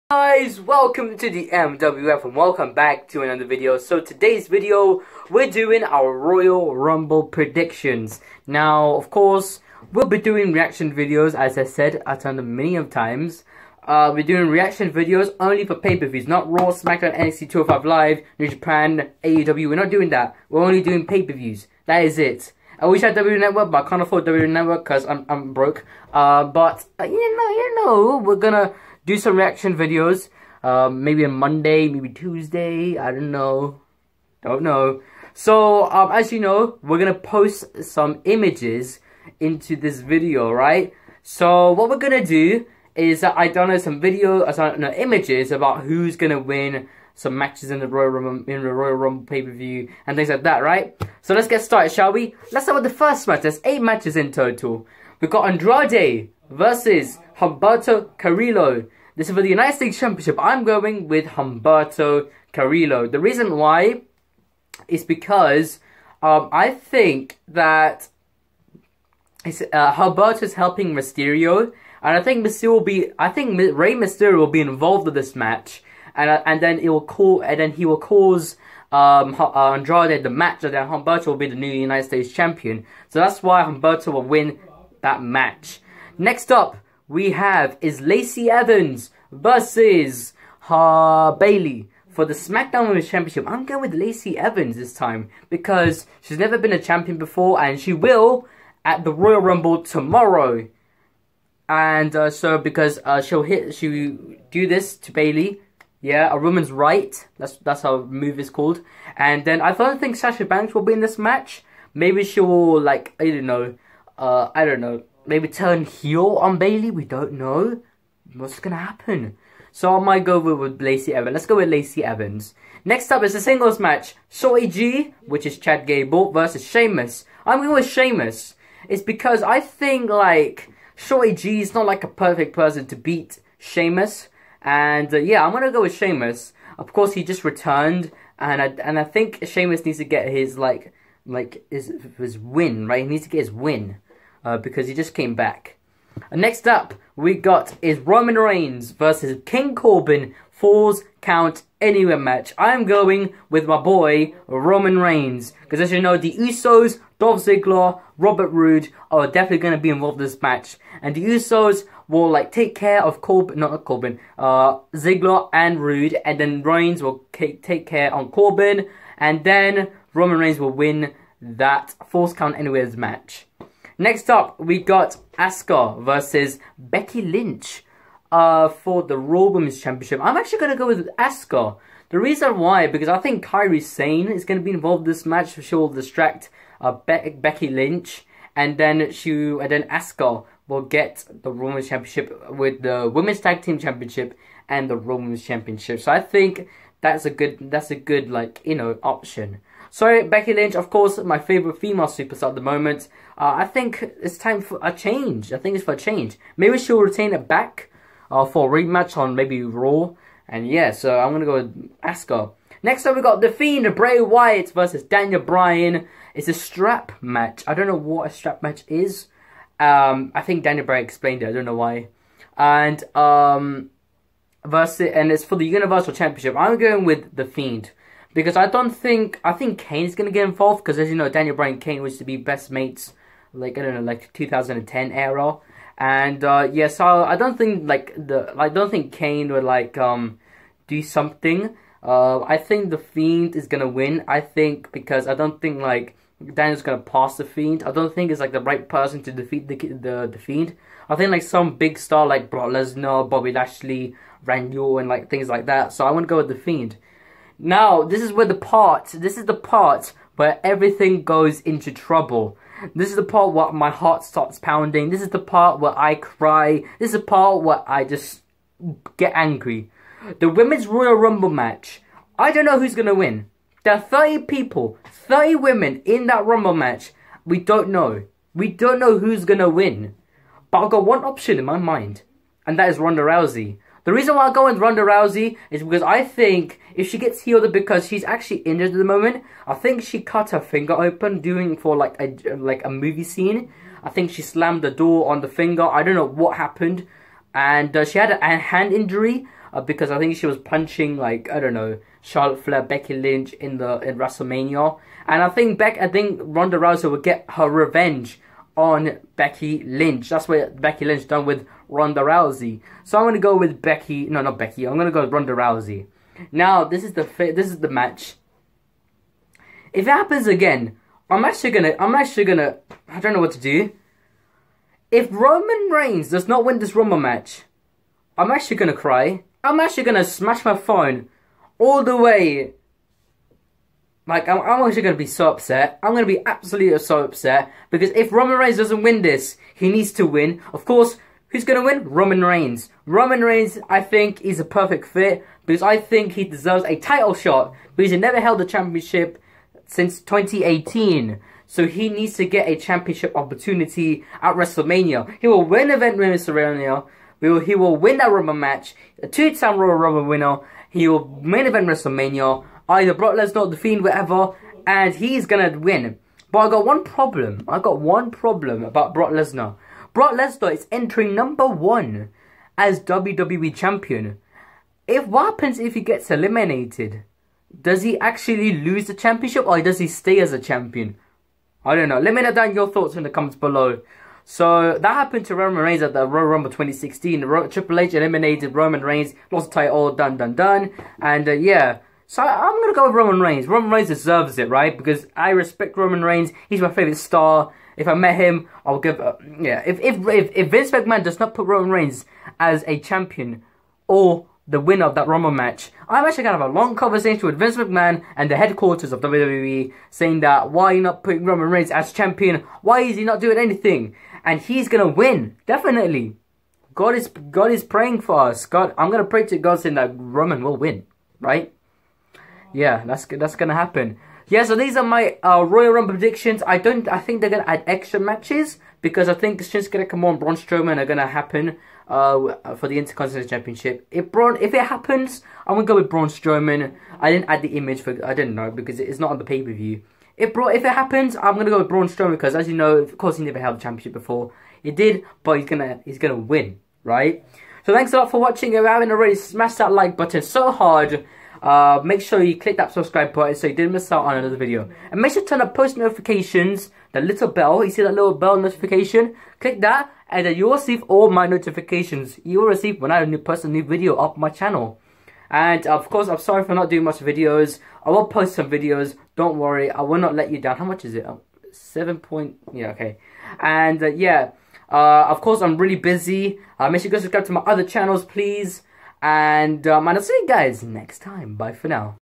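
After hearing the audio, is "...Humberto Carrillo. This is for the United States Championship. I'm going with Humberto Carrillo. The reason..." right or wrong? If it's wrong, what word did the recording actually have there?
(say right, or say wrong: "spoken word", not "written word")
right.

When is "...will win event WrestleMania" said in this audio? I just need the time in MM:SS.
05:55.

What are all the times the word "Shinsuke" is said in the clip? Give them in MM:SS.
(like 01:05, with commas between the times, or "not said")
07:09.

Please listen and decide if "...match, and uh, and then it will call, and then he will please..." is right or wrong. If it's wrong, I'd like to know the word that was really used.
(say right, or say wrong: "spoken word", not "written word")
wrong: "cause", not "please".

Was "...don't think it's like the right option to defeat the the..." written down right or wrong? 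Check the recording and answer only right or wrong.
wrong.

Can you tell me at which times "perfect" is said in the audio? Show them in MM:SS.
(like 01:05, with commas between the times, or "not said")
02:12, 05:44.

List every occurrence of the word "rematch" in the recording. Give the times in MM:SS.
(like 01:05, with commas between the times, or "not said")
03:28.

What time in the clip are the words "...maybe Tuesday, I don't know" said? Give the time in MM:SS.
00:31.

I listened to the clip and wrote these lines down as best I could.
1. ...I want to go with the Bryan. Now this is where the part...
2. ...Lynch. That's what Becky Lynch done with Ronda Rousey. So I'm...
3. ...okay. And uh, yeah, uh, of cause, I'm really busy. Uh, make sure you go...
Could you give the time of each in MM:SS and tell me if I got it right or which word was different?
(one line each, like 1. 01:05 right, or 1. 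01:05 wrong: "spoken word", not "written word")
1. 04:16 wrong: "Fiend", not "Bryan"
2. 05:09 right
3. 07:52 wrong: "course", not "cause".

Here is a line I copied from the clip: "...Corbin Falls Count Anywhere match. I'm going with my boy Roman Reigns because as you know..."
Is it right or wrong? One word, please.
right.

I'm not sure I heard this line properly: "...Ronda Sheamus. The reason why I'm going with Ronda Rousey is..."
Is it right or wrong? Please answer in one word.
wrong.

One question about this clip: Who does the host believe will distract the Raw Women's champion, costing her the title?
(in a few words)
Kairi Sane.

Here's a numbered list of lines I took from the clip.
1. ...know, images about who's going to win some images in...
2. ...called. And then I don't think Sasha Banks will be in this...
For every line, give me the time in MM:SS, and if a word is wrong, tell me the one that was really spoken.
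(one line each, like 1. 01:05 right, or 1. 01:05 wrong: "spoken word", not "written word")
1. 00:44 wrong: "matches", not "images"
2. 01:48 right.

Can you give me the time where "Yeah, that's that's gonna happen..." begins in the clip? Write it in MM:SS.
07:02.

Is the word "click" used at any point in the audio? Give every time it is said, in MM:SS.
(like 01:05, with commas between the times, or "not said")
07:32, 07:39.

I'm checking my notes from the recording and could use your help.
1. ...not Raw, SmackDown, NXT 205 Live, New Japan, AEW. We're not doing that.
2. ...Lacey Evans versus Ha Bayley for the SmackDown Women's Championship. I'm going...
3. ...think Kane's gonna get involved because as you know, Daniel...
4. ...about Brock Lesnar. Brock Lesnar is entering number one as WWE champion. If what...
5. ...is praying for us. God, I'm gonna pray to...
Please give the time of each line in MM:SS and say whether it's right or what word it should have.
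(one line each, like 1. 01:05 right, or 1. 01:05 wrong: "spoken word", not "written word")
1. 00:16 right
2. 01:28 right
3. 03:49 right
4. 06:08 right
5. 06:57 right.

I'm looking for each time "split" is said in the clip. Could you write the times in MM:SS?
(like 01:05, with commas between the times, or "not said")
not said.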